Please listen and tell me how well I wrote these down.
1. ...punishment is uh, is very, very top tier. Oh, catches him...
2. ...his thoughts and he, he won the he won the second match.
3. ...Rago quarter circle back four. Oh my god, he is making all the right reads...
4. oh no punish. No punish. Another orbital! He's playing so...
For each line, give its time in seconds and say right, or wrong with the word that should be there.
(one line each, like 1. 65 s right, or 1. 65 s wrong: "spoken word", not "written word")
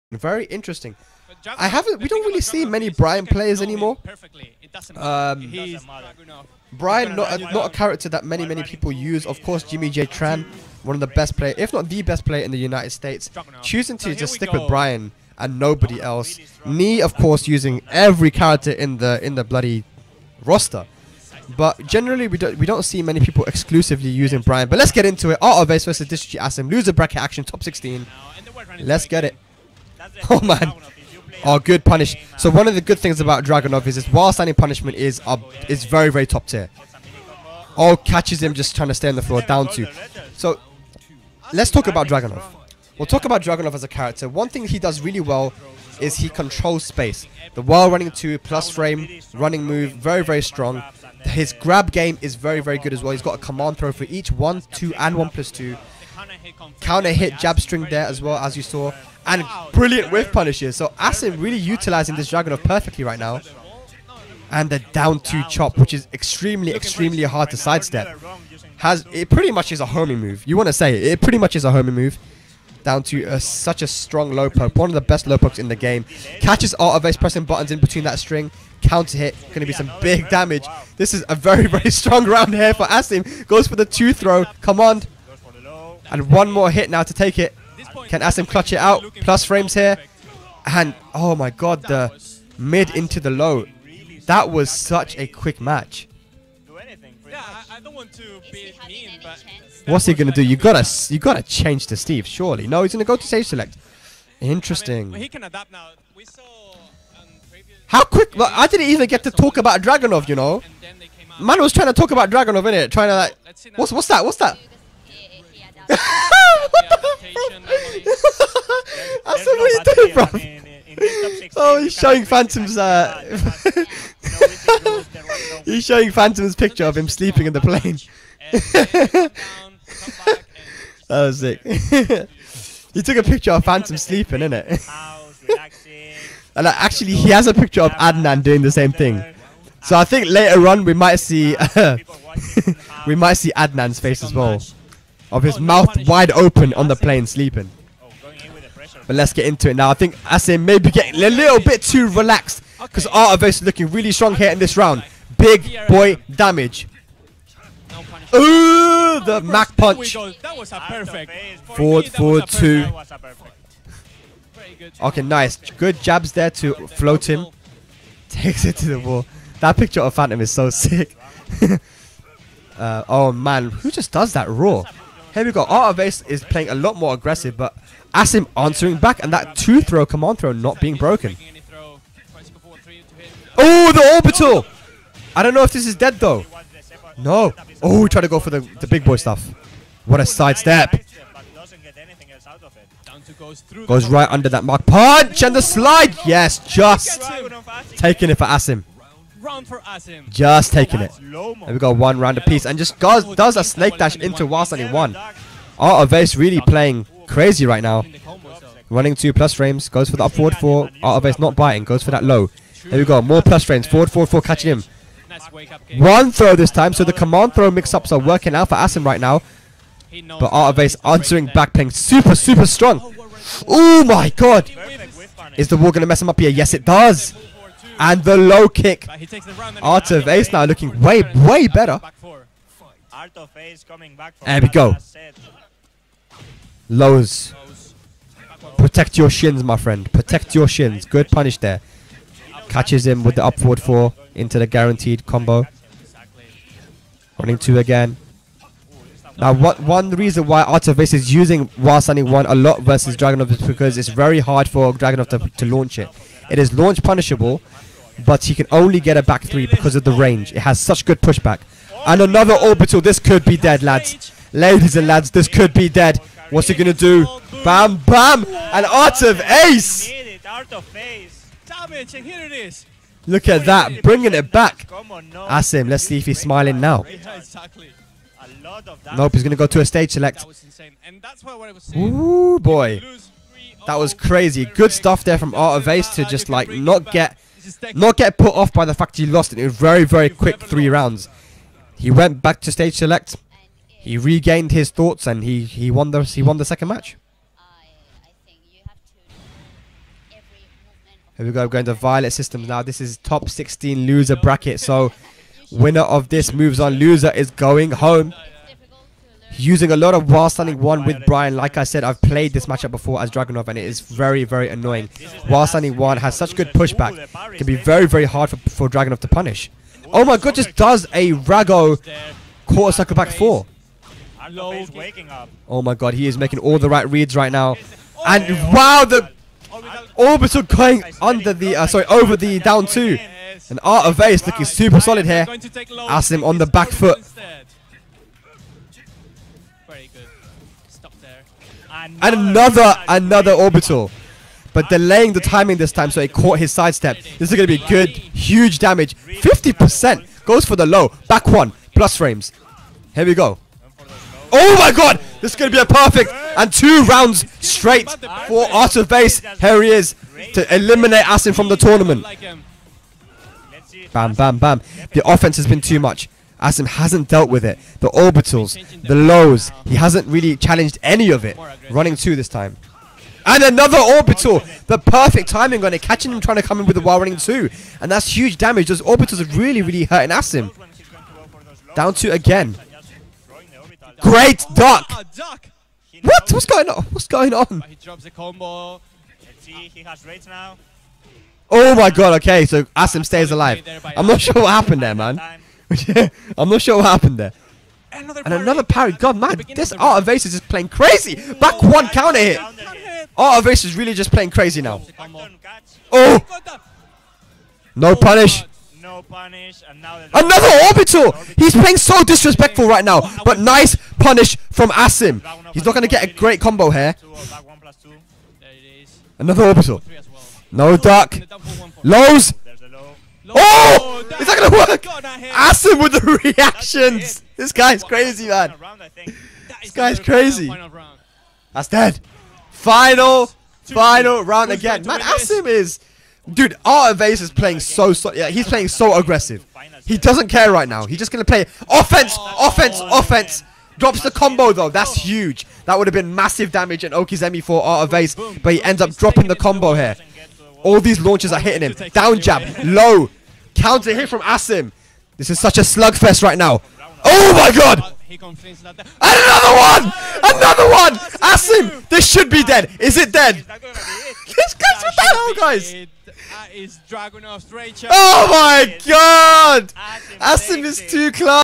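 1. 34 s right
2. 294 s right
3. 321 s right
4. 406 s right.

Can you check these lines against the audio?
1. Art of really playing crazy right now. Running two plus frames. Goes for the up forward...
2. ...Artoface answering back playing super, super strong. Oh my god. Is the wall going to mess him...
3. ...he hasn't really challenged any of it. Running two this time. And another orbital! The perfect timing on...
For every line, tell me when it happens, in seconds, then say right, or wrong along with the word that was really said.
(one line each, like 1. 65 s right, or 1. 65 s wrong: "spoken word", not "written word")
1. 205 s right
2. 220 s right
3. 369 s right.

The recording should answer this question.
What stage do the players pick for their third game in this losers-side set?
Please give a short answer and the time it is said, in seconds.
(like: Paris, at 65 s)
Violet Systems, at 301 s.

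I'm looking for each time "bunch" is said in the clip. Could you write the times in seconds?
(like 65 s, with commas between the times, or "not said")
not said.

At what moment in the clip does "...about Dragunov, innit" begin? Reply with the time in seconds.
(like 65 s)
112 s.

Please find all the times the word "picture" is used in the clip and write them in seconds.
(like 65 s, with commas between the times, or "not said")
126 s, 133 s, 137 s, 169 s.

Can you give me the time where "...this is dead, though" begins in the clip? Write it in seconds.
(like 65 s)
185 s.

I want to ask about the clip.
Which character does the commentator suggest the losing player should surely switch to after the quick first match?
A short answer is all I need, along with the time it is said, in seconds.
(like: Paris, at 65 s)
Steve, at 101 s.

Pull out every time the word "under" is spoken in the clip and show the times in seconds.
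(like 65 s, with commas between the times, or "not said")
194 s, 331 s.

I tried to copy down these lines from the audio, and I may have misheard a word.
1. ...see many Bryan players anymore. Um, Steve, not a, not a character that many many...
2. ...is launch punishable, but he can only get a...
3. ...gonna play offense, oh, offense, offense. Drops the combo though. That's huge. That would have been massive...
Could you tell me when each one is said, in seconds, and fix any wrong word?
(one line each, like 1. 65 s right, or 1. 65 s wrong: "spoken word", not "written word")
1. 2 s wrong: "Bryan", not "Steve"
2. 256 s right
3. 441 s right.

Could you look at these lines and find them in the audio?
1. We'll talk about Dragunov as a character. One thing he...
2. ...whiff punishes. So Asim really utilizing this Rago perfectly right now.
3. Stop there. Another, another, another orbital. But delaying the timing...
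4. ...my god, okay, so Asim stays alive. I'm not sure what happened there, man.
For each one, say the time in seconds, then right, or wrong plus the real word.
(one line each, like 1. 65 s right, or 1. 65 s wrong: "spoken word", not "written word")
1. 42 s right
2. 60 s wrong: "Dragunov", not "Rago"
3. 340 s right
4. 391 s right.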